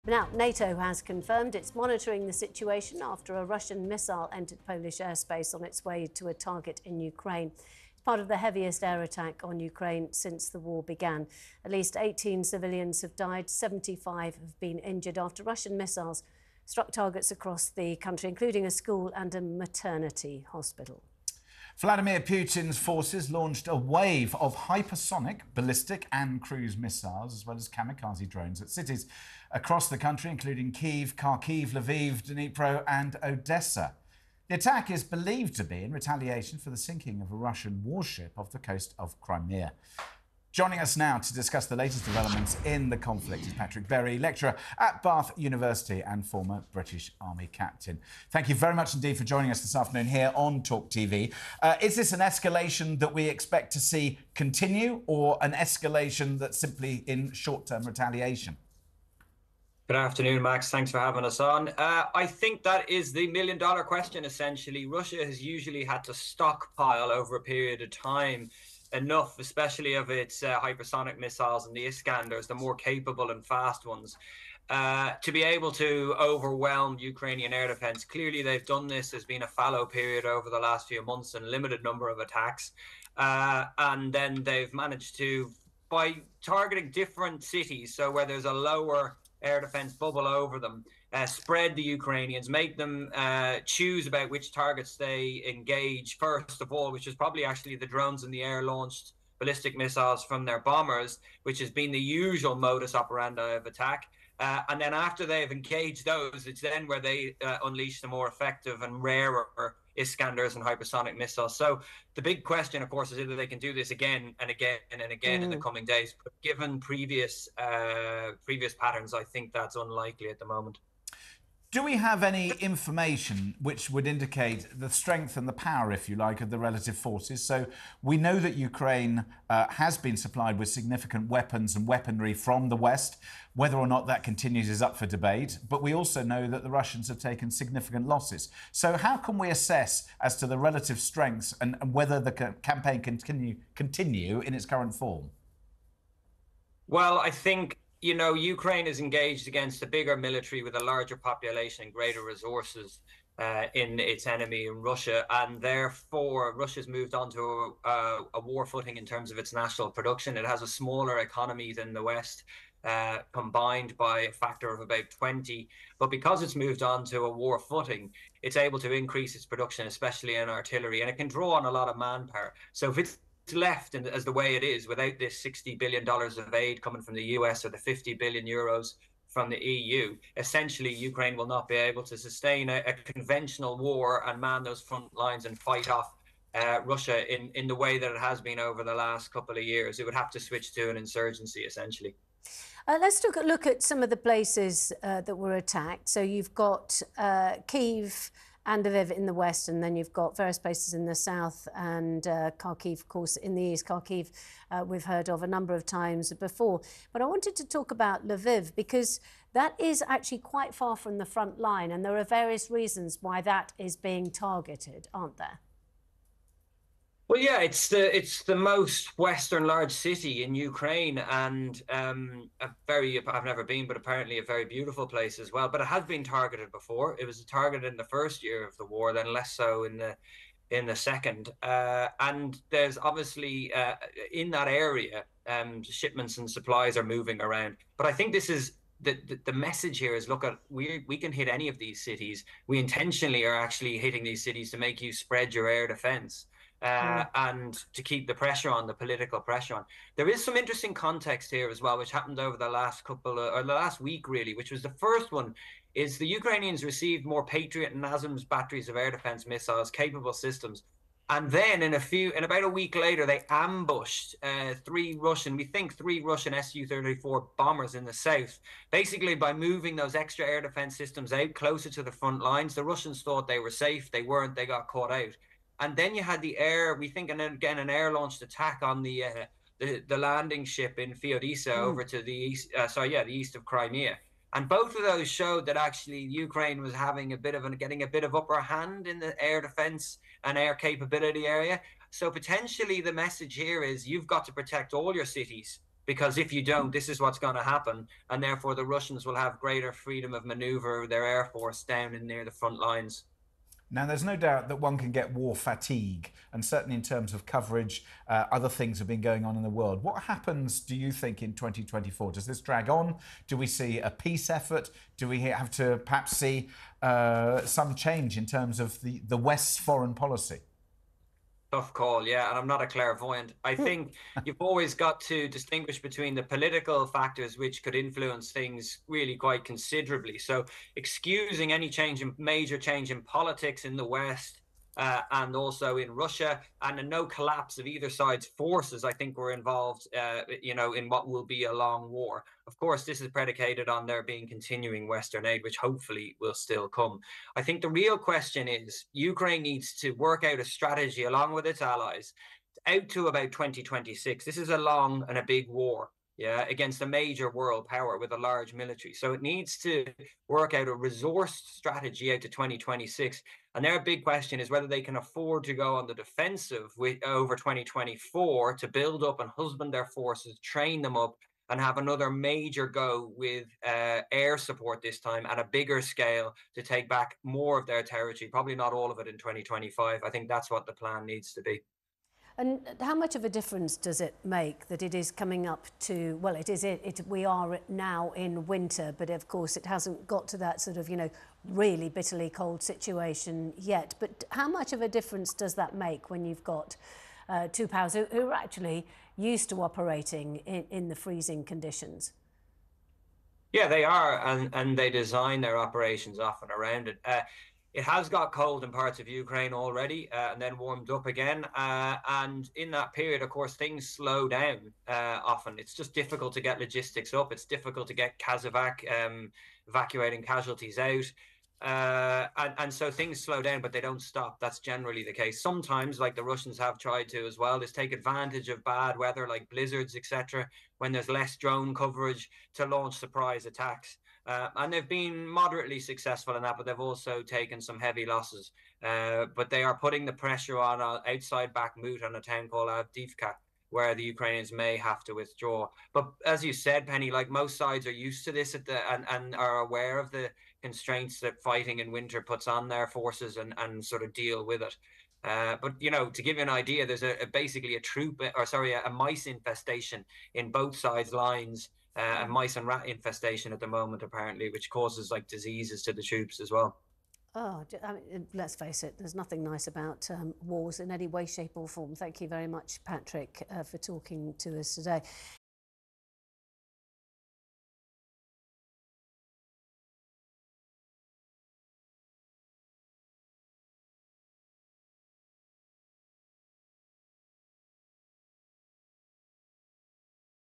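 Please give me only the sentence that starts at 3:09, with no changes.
It would have to switch to an insurgency, essentially.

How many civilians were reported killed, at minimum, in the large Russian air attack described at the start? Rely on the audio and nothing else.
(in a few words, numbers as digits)
18.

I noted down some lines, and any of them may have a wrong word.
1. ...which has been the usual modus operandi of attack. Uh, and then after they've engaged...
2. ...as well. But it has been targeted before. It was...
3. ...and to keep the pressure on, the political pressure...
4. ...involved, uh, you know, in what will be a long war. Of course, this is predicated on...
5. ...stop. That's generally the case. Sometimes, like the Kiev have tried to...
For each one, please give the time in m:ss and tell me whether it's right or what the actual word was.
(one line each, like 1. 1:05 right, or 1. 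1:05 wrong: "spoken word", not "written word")
1. 1:41 right
2. 3:45 right
3. 4:07 right
4. 5:39 right
5. 7:04 wrong: "Russians", not "Kiev".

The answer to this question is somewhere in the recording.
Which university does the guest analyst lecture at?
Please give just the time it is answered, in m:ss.
0:45.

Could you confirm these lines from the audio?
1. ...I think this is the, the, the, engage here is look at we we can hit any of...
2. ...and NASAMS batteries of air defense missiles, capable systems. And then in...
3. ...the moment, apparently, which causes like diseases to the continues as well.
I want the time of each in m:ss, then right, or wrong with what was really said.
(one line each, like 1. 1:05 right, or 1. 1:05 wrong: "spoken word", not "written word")
1. 3:58 wrong: "message", not "engage"
2. 4:17 right
3. 7:43 wrong: "tubes", not "continues".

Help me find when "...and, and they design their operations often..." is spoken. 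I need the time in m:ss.
6:44.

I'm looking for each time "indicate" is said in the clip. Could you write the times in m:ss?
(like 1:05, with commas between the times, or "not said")
2:04.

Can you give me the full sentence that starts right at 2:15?
But we also know that the Russians have taken significant losses.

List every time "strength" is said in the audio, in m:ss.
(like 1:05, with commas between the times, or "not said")
2:04, 2:20.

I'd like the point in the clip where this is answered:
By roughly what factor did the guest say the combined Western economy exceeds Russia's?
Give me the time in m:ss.
2:45.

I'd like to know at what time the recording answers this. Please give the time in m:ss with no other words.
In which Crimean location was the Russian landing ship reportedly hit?
4:41.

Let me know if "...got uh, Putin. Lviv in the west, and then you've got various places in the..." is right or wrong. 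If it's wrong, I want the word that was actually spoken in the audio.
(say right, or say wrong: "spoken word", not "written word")
wrong: "Kiev", not "Putin".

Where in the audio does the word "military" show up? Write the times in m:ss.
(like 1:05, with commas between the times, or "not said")
2:30, 5:58.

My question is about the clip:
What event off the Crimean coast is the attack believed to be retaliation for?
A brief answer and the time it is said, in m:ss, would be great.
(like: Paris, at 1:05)
sinking of a Russian warship, at 0:36.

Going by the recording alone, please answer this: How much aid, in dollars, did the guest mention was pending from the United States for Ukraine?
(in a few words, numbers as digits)
$60 billion.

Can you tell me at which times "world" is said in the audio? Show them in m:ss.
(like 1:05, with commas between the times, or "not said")
5:09, 5:57.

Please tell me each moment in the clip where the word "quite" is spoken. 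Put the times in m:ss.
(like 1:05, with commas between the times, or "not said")
3:30, 5:29.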